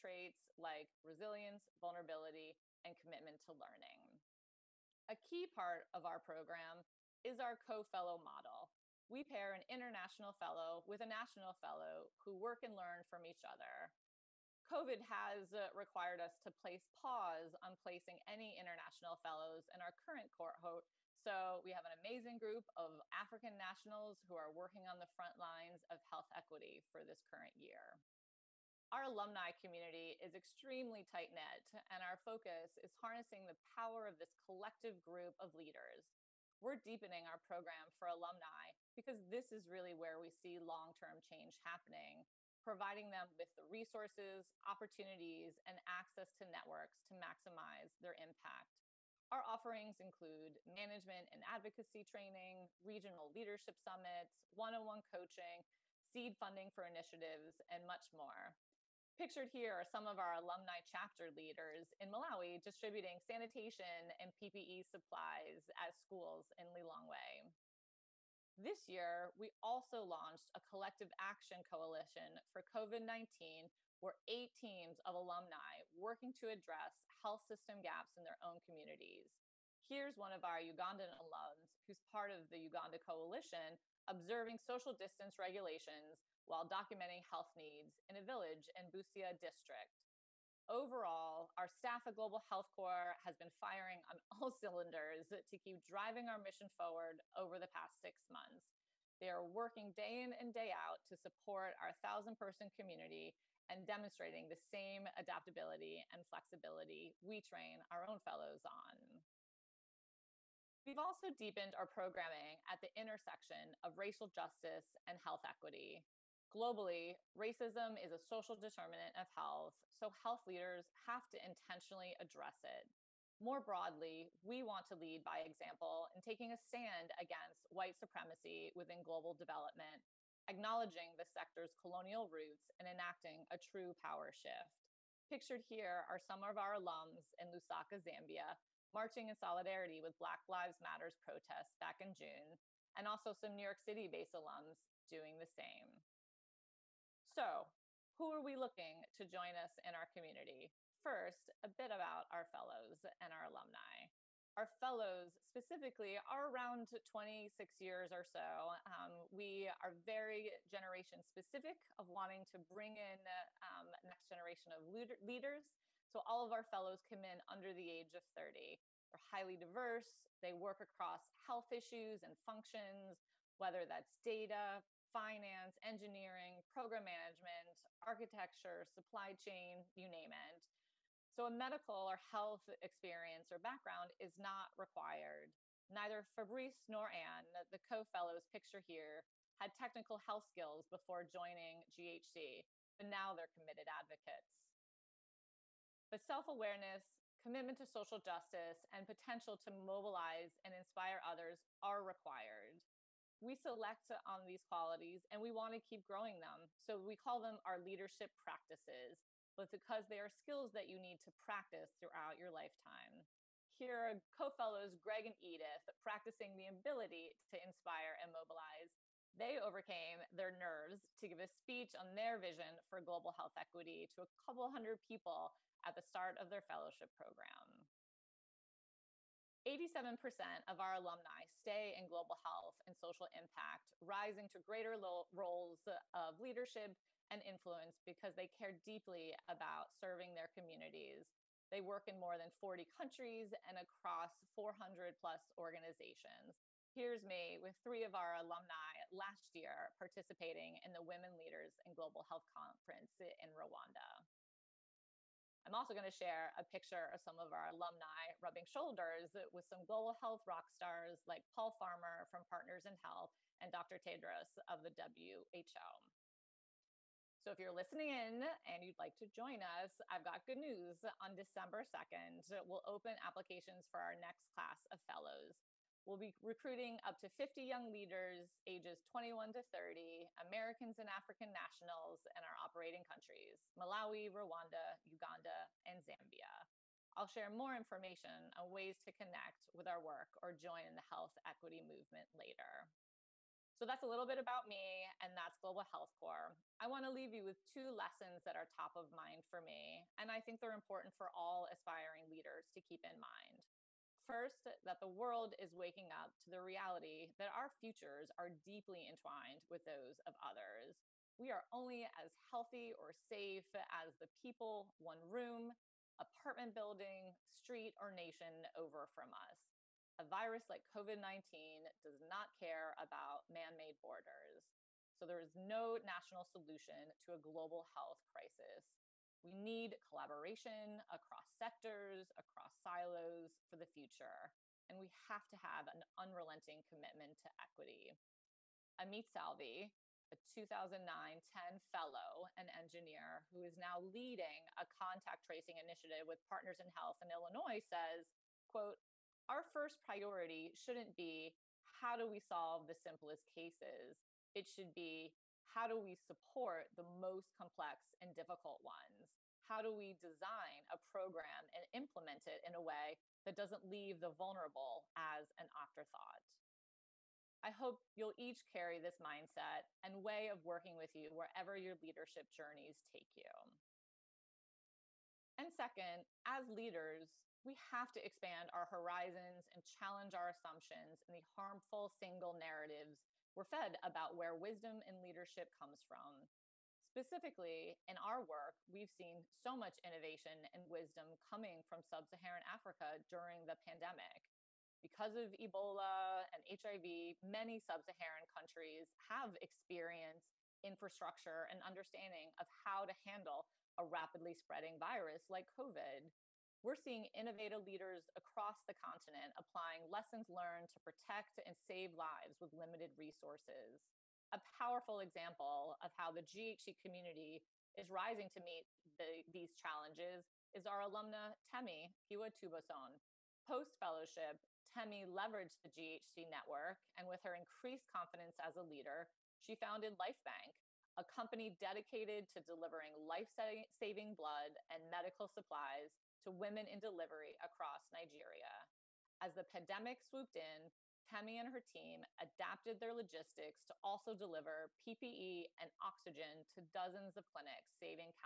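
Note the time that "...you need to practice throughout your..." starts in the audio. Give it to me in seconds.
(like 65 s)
210 s.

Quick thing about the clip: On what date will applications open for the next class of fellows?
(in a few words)
December 2.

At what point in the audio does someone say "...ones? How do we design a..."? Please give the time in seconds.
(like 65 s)
358 s.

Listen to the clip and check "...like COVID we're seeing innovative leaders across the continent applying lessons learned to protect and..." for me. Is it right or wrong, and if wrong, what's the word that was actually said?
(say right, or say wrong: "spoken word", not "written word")
right.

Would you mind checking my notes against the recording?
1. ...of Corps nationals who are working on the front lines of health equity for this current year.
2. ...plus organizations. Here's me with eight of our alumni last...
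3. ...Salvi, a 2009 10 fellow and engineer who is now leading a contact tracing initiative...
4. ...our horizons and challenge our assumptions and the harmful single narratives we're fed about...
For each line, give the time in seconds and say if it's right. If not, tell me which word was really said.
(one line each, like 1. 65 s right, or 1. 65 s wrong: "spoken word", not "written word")
1. 22 s wrong: "African", not "Corps"
2. 245 s wrong: "three", not "eight"
3. 339 s right
4. 378 s right.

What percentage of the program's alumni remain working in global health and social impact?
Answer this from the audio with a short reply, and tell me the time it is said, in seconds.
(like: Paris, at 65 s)
87%, at 229 s.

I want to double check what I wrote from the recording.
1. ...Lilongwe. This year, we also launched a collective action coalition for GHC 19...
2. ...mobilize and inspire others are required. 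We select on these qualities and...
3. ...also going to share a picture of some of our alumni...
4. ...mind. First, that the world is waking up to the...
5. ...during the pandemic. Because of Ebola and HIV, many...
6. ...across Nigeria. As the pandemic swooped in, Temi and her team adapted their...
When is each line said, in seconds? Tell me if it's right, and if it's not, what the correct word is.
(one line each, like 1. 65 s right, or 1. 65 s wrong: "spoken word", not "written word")
1. 66 s wrong: "COVID", not "GHC"
2. 199 s right
3. 255 s right
4. 303 s right
5. 393 s right
6. 437 s right.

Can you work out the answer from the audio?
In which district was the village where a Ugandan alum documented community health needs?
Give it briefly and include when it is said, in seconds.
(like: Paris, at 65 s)
Busia, at 88 s.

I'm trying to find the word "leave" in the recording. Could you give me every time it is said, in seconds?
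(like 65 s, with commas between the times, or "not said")
297 s, 363 s.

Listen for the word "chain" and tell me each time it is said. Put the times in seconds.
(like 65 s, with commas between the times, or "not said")
179 s.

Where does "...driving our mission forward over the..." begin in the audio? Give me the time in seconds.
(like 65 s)
95 s.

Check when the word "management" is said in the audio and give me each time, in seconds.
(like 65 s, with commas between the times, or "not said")
50 s, 177 s.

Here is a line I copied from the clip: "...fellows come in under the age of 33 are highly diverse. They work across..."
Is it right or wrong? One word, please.
wrong.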